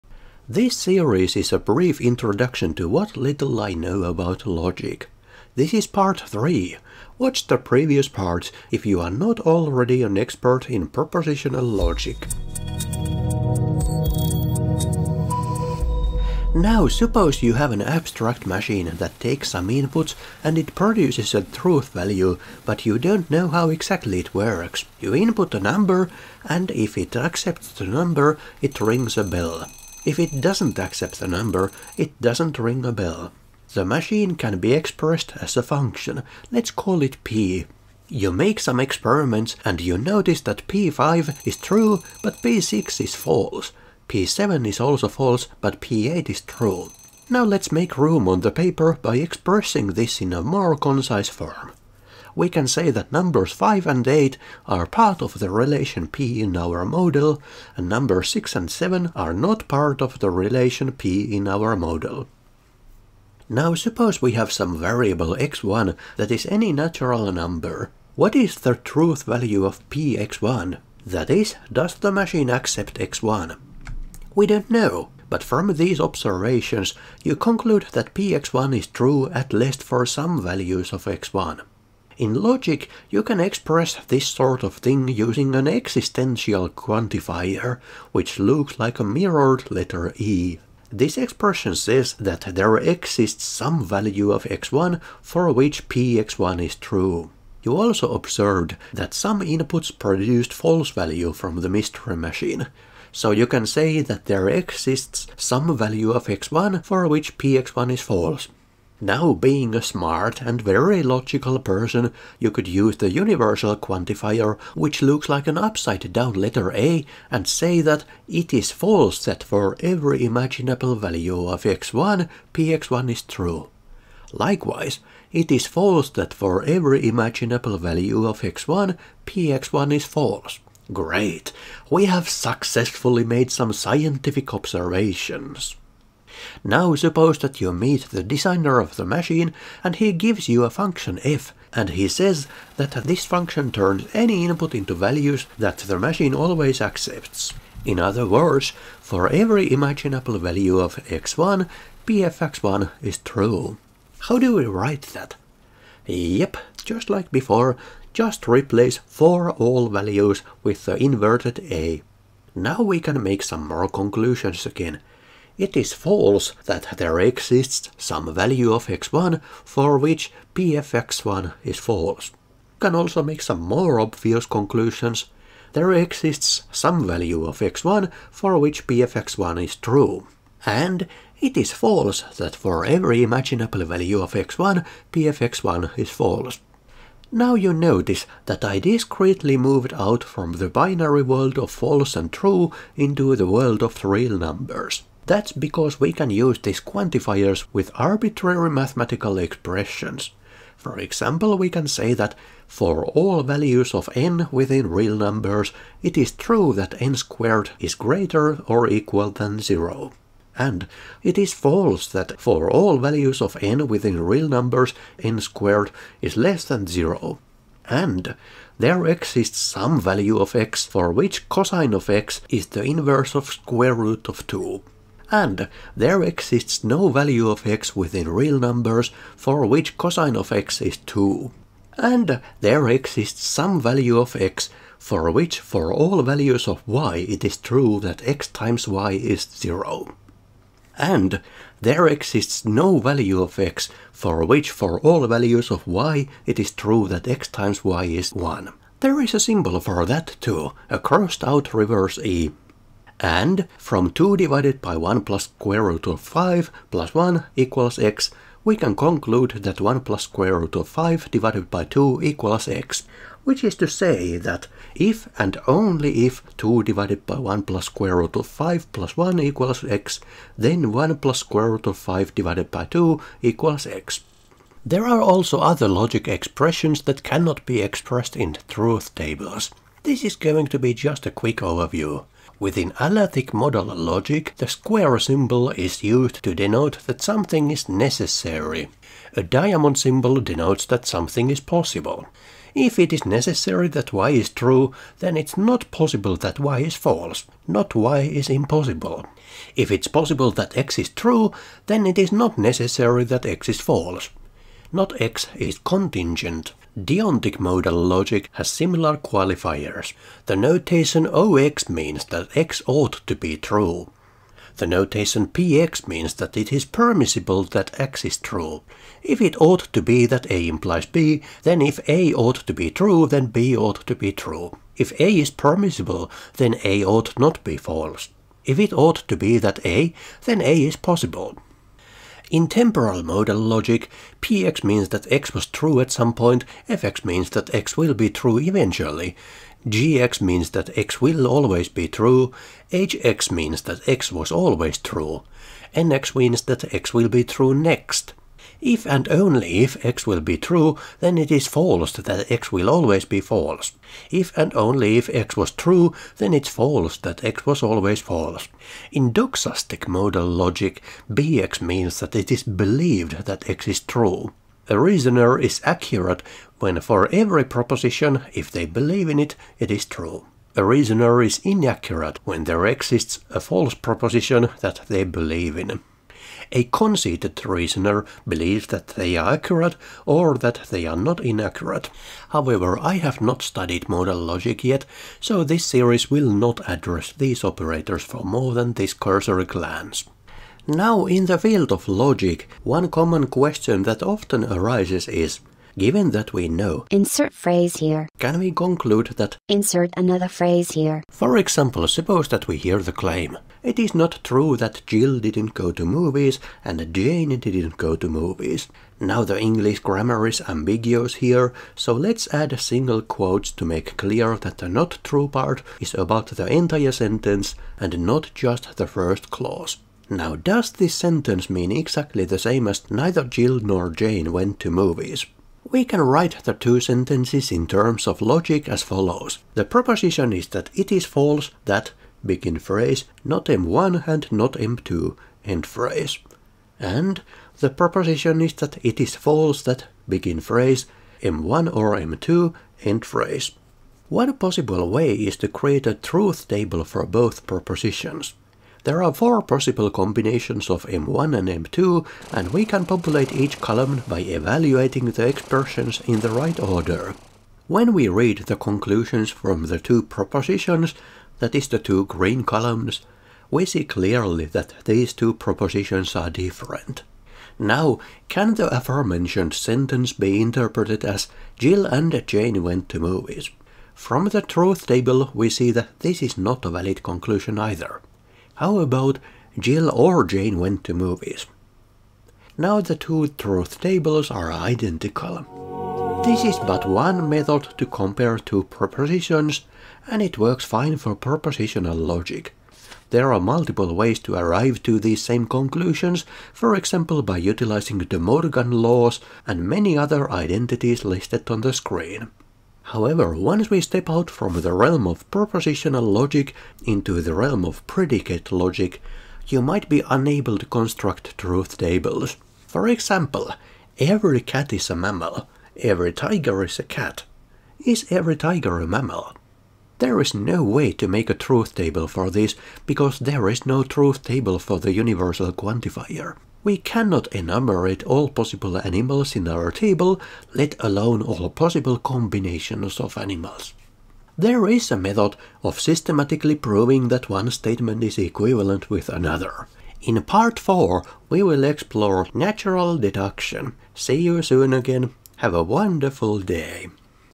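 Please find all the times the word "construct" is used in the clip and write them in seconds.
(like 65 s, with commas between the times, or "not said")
510 s.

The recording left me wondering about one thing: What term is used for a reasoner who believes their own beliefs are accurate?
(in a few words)
Conceited.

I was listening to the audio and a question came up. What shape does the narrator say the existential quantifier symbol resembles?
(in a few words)
A mirrored letter E.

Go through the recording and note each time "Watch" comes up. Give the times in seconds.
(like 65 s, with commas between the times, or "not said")
7 s.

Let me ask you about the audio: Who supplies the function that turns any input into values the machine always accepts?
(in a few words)
The designer of the machine.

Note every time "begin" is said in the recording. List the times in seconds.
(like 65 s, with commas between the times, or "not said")
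432 s, 440 s.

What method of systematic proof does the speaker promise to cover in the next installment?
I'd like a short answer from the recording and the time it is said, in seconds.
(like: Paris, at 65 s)
Natural deduction, at 542 s.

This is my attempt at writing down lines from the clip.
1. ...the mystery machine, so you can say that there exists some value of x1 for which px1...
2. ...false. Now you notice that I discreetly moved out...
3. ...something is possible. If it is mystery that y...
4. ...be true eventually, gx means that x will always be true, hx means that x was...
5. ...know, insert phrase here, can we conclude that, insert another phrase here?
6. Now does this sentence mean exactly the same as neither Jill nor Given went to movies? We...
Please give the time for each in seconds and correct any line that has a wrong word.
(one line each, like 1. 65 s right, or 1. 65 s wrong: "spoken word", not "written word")
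1. 101 s right
2. 186 s right
3. 291 s wrong: "necessary", not "mystery"
4. 338 s right
5. 396 s right
6. 420 s wrong: "Jane", not "Given".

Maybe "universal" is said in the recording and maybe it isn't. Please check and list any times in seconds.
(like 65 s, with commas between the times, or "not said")
113 s, 525 s.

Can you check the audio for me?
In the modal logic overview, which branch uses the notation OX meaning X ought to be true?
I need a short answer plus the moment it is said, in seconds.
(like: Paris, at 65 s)
Deontic modal logic, at 306 s.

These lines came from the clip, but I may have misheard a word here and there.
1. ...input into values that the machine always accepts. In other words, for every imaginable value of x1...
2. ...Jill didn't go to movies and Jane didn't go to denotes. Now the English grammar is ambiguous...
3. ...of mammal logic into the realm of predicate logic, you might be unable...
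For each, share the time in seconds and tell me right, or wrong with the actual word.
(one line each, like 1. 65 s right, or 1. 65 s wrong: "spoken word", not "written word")
1. 144 s right
2. 405 s wrong: "movies", not "denotes"
3. 505 s wrong: "propositional", not "mammal".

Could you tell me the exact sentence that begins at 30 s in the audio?
If it doesn't accept the number, it doesn't ring a bell.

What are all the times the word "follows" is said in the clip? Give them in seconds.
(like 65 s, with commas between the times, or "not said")
429 s.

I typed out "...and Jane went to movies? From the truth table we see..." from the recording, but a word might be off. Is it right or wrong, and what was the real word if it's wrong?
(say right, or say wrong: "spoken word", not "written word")
right.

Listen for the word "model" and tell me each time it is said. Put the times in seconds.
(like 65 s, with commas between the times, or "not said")
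56 s, 61 s.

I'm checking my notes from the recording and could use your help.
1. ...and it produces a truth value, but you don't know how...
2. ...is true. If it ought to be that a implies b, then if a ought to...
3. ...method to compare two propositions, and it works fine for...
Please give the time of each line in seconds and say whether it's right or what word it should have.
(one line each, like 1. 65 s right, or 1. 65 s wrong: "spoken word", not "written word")
1. 20 s right
2. 318 s right
3. 487 s right.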